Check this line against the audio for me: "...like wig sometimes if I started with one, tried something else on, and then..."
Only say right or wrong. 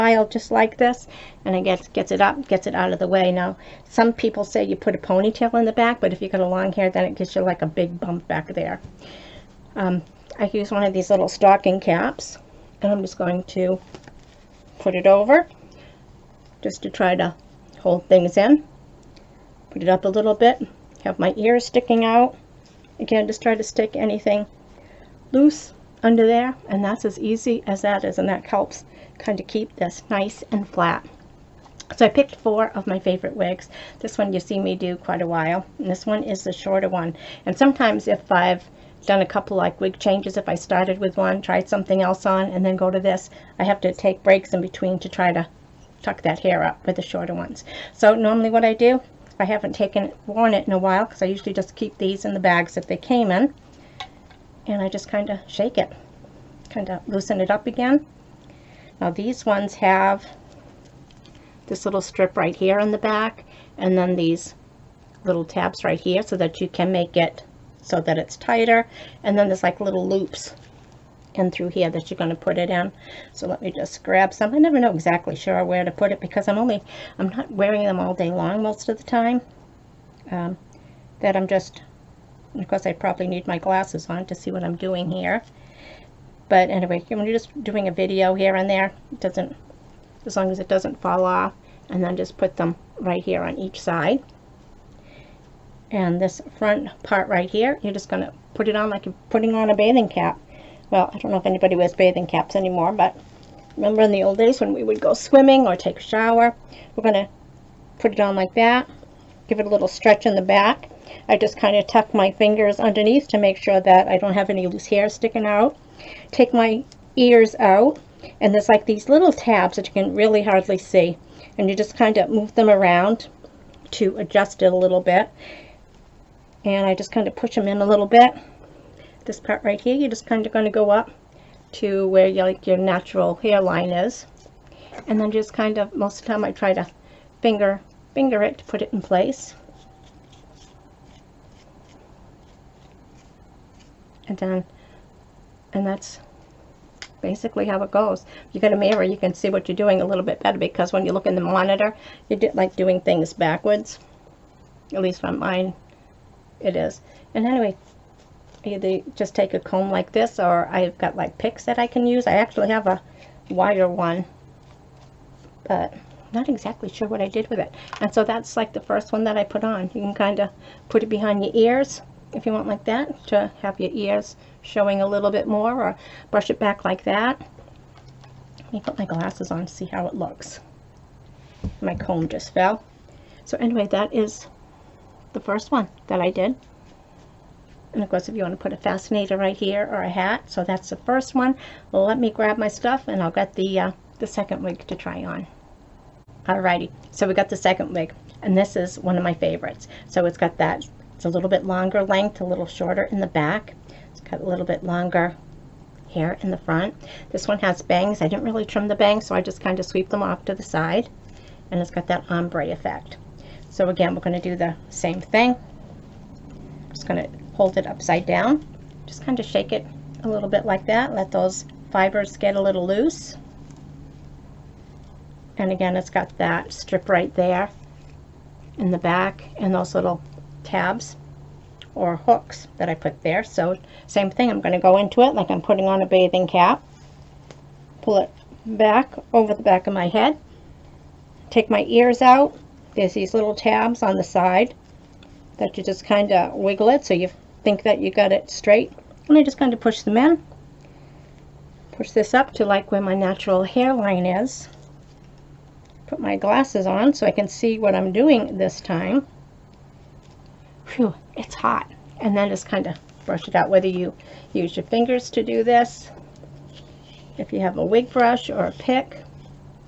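wrong.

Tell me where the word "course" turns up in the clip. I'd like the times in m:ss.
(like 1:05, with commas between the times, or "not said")
1:22, 3:08.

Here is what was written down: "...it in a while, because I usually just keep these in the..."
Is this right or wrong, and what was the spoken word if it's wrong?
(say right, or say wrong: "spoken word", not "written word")
right.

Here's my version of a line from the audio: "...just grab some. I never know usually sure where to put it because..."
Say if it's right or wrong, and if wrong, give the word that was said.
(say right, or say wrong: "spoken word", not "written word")
wrong: "exactly", not "usually".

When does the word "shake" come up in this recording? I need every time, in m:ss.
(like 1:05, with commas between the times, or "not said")
0:55, 3:39.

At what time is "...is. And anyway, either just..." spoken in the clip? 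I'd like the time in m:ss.
2:36.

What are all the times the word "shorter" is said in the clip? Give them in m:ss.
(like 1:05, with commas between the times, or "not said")
0:36, 0:47, 3:22.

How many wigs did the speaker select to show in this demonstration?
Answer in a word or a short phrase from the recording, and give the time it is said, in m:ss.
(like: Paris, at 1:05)
4, at 0:32.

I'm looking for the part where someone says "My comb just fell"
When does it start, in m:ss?
3:01.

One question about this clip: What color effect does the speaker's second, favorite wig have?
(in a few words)
ombre.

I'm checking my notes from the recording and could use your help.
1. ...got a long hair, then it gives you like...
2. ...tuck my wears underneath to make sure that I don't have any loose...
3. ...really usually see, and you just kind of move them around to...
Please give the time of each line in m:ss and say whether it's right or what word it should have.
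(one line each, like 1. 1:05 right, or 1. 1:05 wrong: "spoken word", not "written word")
1. 0:06 right
2. 1:51 wrong: "fingers", not "wears"
3. 2:00 wrong: "hardly", not "usually".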